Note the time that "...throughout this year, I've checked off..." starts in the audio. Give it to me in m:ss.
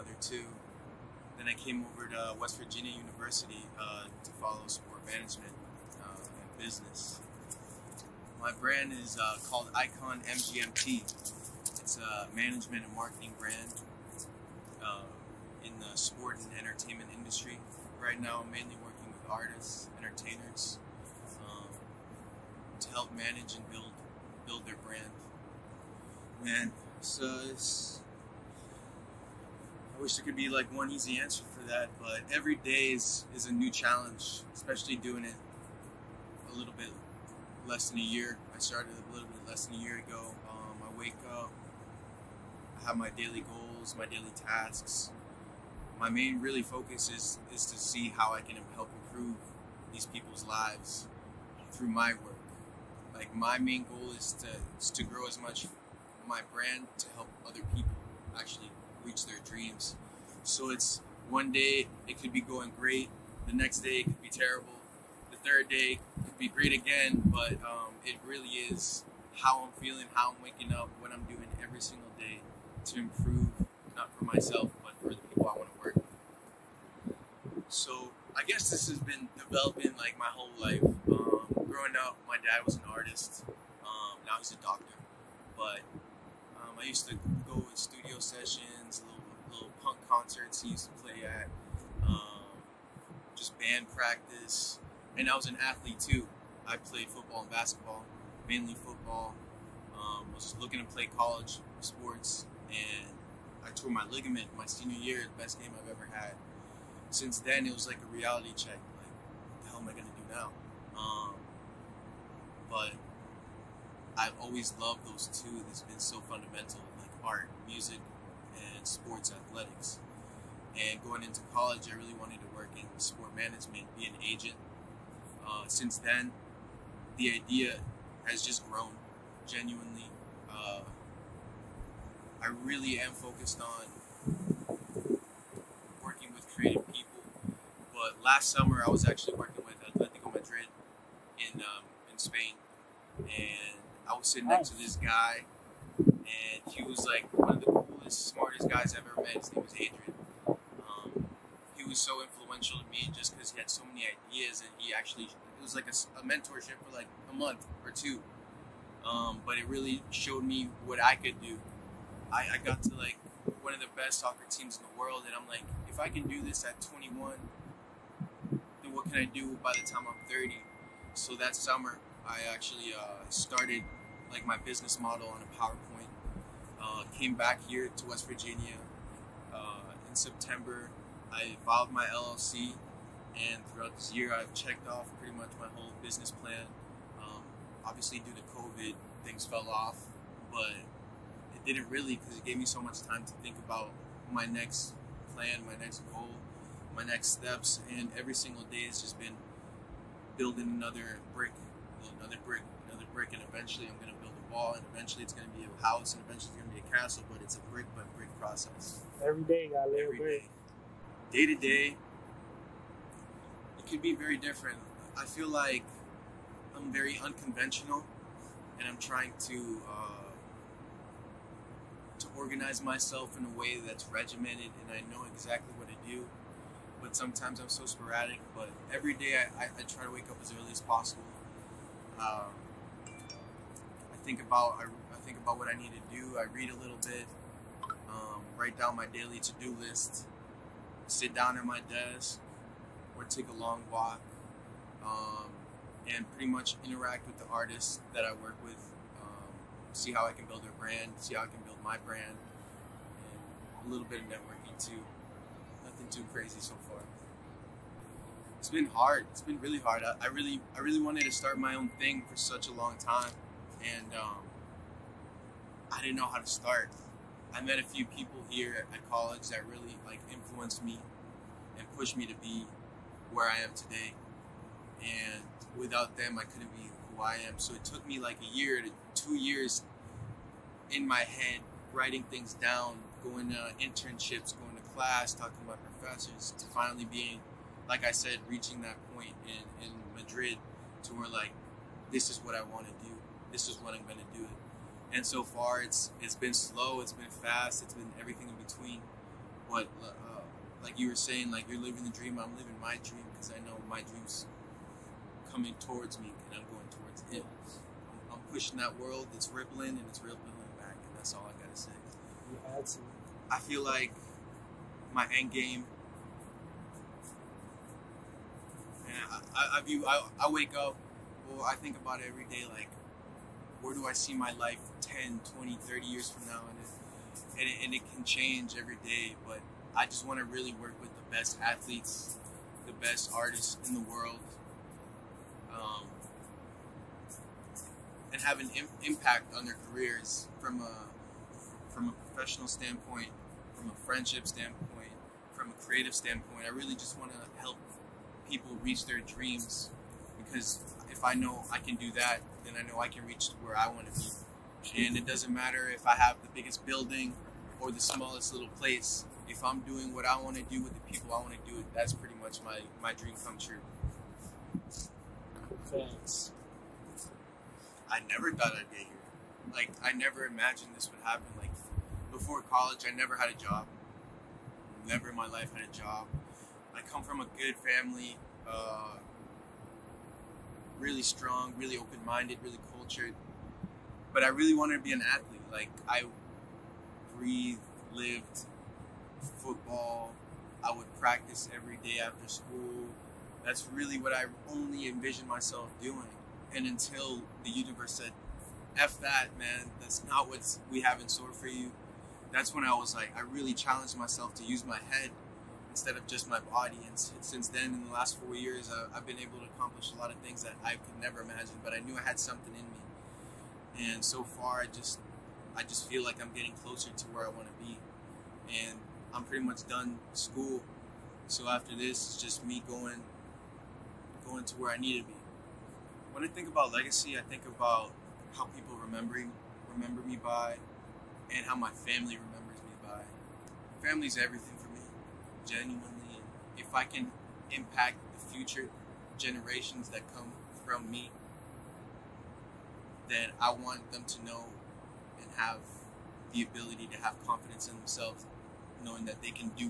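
3:03.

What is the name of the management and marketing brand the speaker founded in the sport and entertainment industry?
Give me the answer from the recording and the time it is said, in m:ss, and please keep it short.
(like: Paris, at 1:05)
Icon MGMT, at 0:09.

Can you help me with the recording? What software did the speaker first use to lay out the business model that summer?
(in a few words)
PowerPoint.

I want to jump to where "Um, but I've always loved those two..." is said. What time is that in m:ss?
1:50.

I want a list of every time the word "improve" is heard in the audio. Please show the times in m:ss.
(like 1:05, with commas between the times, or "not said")
0:49, 1:12.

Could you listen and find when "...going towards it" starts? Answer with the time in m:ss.
5:06.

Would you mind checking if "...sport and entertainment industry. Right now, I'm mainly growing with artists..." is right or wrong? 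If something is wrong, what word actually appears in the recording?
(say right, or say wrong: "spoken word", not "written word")
wrong: "working", not "growing".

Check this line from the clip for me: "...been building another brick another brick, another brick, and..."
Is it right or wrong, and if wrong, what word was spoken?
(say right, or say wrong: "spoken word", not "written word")
right.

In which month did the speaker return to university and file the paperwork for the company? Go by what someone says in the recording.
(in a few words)
September.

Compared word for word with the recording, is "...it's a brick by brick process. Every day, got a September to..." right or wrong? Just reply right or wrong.
wrong.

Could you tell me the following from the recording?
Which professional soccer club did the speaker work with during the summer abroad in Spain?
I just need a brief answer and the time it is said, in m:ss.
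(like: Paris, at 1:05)
Atletico Madrid, at 2:19.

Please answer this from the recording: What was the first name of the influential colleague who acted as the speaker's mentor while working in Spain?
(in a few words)
Adrian.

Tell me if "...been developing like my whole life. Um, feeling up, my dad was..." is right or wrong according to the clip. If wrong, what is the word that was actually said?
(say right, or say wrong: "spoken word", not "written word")
wrong: "growing", not "feeling".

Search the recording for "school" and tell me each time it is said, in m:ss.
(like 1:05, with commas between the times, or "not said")
6:32, 7:00.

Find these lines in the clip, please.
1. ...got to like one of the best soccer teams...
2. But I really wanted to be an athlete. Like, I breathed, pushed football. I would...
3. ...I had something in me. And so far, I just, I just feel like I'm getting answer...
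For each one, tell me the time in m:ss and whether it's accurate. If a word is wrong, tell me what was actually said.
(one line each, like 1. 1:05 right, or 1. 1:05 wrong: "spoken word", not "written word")
1. 2:42 right
2. 6:24 wrong: "lived", not "pushed"
3. 6:52 wrong: "closer", not "answer".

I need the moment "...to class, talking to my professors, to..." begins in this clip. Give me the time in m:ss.
4:44.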